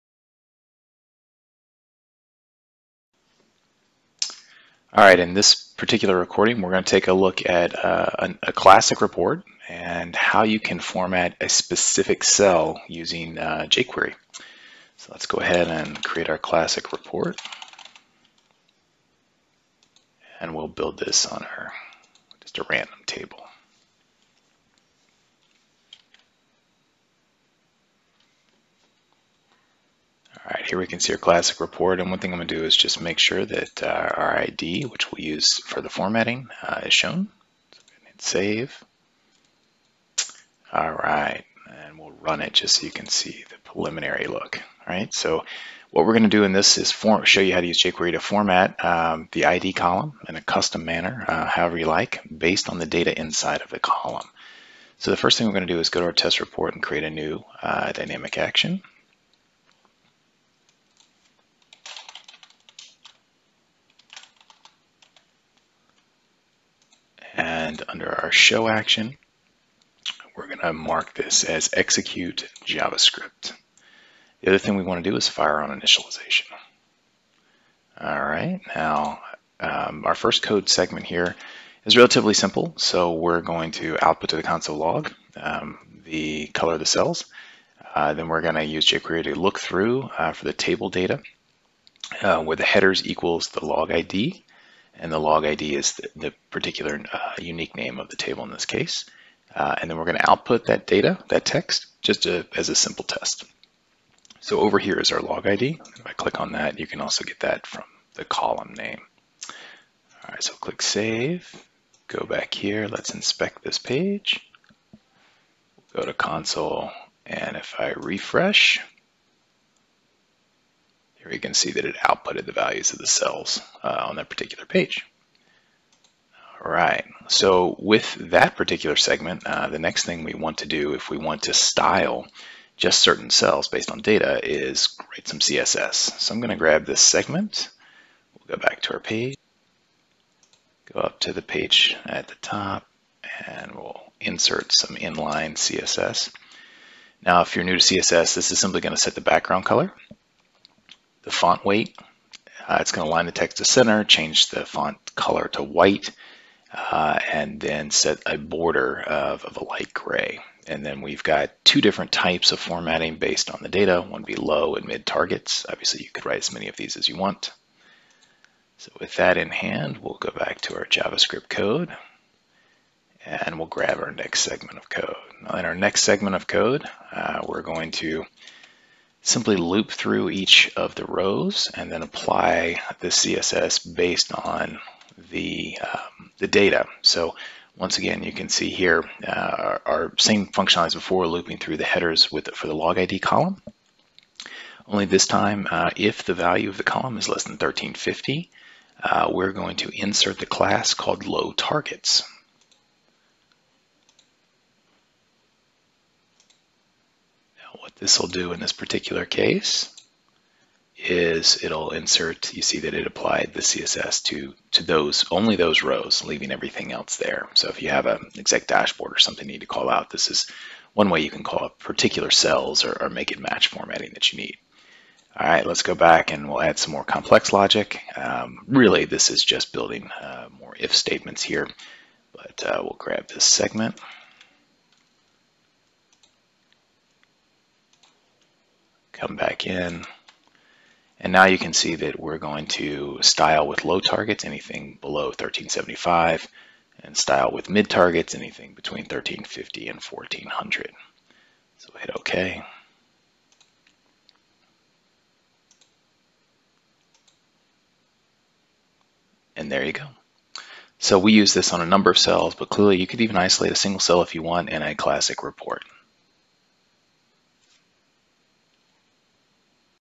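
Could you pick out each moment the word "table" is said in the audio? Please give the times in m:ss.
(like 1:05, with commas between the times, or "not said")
0:23, 1:30, 1:38.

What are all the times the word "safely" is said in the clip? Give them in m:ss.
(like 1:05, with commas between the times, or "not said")
not said.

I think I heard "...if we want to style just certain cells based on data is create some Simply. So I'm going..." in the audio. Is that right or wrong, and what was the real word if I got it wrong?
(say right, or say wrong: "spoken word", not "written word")
wrong: "CSS", not "Simply".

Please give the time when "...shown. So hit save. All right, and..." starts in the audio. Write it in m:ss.
0:36.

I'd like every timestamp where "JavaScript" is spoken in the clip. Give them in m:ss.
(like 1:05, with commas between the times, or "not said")
1:12, 2:50.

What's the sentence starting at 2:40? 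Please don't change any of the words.
And then we've got two different types of formatting based on the data.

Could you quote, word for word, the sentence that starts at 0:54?
So the first thing we're gonna do is go to our test report and create a new uh, dynamic action.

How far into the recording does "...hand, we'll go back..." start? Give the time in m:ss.
2:49.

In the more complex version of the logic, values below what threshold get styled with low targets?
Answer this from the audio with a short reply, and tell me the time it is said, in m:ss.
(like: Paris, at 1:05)
1375, at 4:05.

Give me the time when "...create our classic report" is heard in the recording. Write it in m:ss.
0:16.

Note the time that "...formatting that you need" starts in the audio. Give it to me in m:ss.
3:43.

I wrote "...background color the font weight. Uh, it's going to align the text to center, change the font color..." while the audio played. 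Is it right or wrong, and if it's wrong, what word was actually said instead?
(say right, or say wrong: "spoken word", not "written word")
right.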